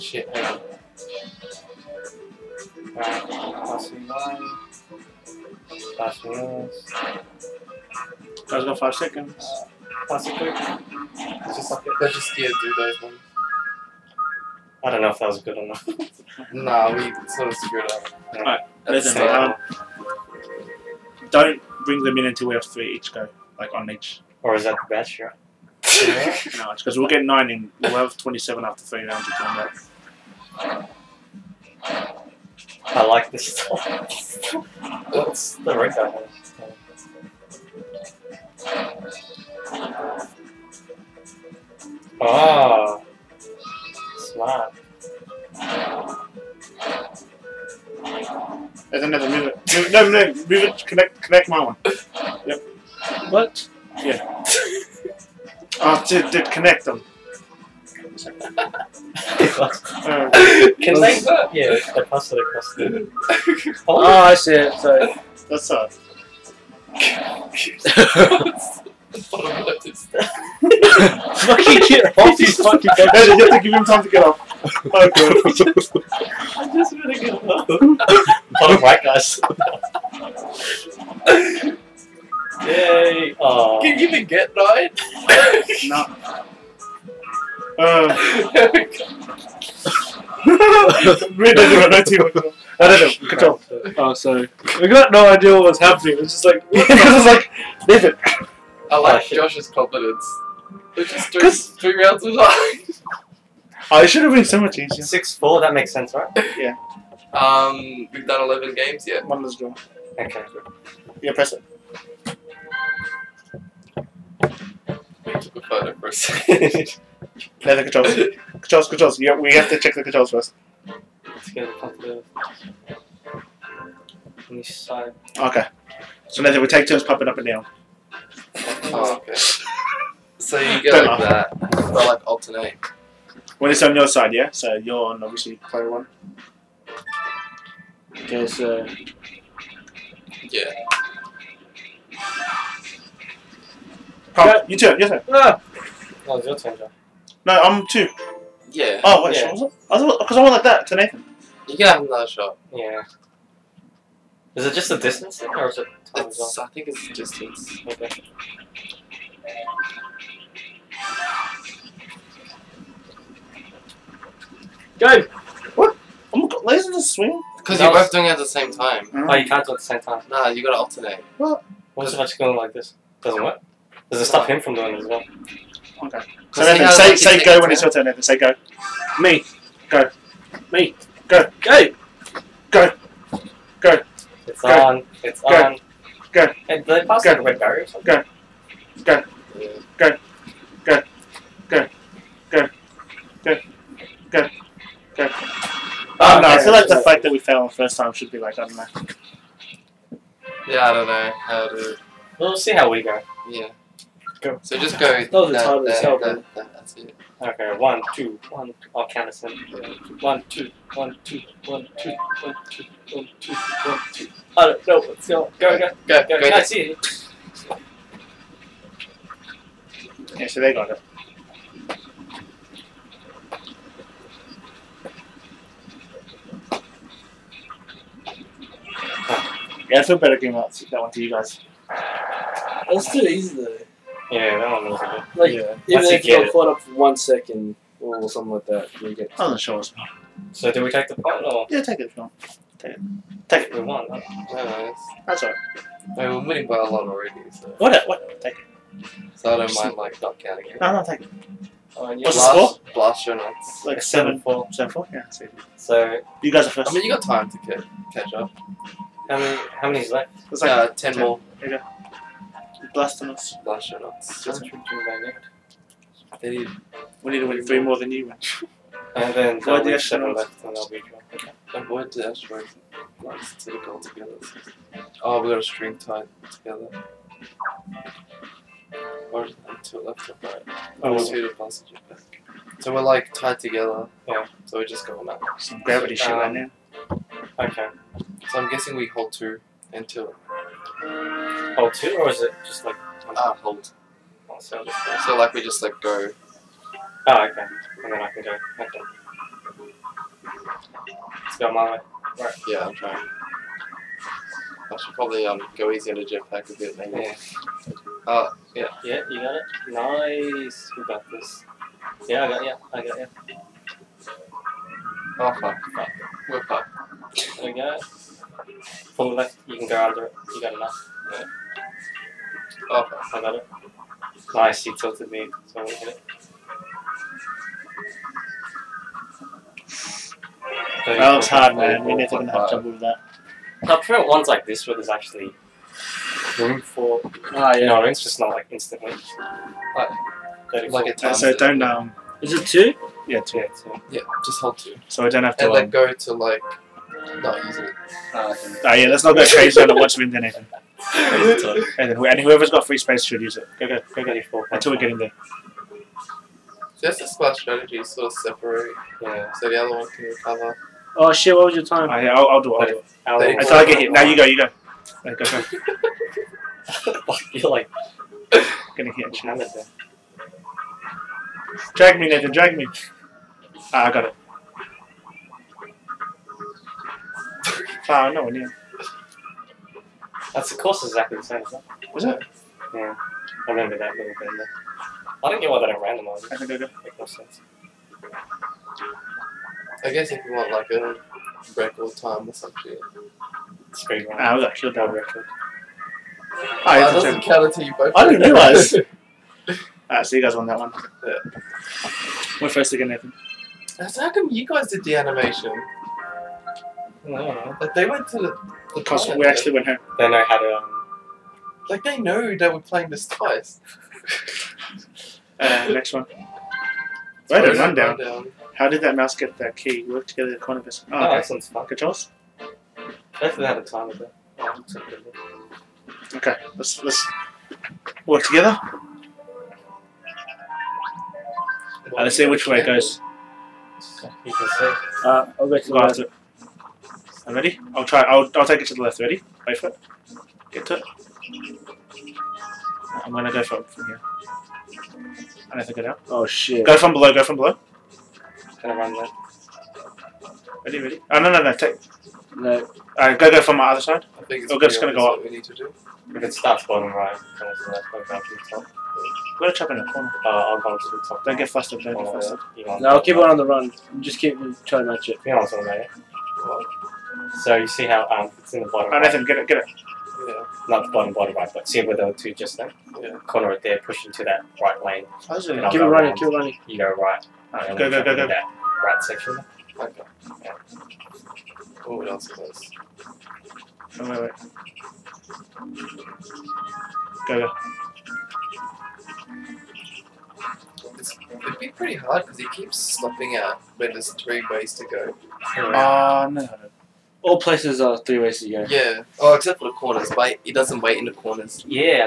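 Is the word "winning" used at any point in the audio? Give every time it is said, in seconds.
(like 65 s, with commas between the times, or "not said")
246 s.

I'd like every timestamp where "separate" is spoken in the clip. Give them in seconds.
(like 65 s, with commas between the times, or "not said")
205 s, 358 s.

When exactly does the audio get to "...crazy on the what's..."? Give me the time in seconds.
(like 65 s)
349 s.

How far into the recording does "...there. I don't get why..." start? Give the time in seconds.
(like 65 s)
384 s.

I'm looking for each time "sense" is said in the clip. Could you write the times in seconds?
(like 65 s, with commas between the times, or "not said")
105 s, 387 s.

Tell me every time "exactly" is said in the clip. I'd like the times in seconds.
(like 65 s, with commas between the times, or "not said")
381 s.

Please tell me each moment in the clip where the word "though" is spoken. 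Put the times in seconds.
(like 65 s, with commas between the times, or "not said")
233 s.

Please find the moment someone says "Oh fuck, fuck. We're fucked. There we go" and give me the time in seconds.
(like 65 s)
315 s.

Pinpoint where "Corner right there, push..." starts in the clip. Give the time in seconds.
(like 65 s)
473 s.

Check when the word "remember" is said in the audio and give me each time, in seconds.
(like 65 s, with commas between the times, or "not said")
383 s.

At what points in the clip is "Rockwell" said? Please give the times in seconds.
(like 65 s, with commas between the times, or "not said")
not said.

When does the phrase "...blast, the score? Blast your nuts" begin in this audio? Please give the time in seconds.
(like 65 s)
252 s.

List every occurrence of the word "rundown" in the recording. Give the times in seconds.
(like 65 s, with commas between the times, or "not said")
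417 s.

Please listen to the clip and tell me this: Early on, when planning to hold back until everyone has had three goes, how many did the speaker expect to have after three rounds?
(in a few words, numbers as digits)
27.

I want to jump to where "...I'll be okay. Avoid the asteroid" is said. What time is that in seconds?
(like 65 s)
270 s.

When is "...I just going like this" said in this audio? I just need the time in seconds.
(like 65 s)
172 s.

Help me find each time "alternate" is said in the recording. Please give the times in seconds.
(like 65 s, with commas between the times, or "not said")
132 s, 170 s.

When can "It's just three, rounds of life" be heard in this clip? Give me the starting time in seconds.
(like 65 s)
100 s.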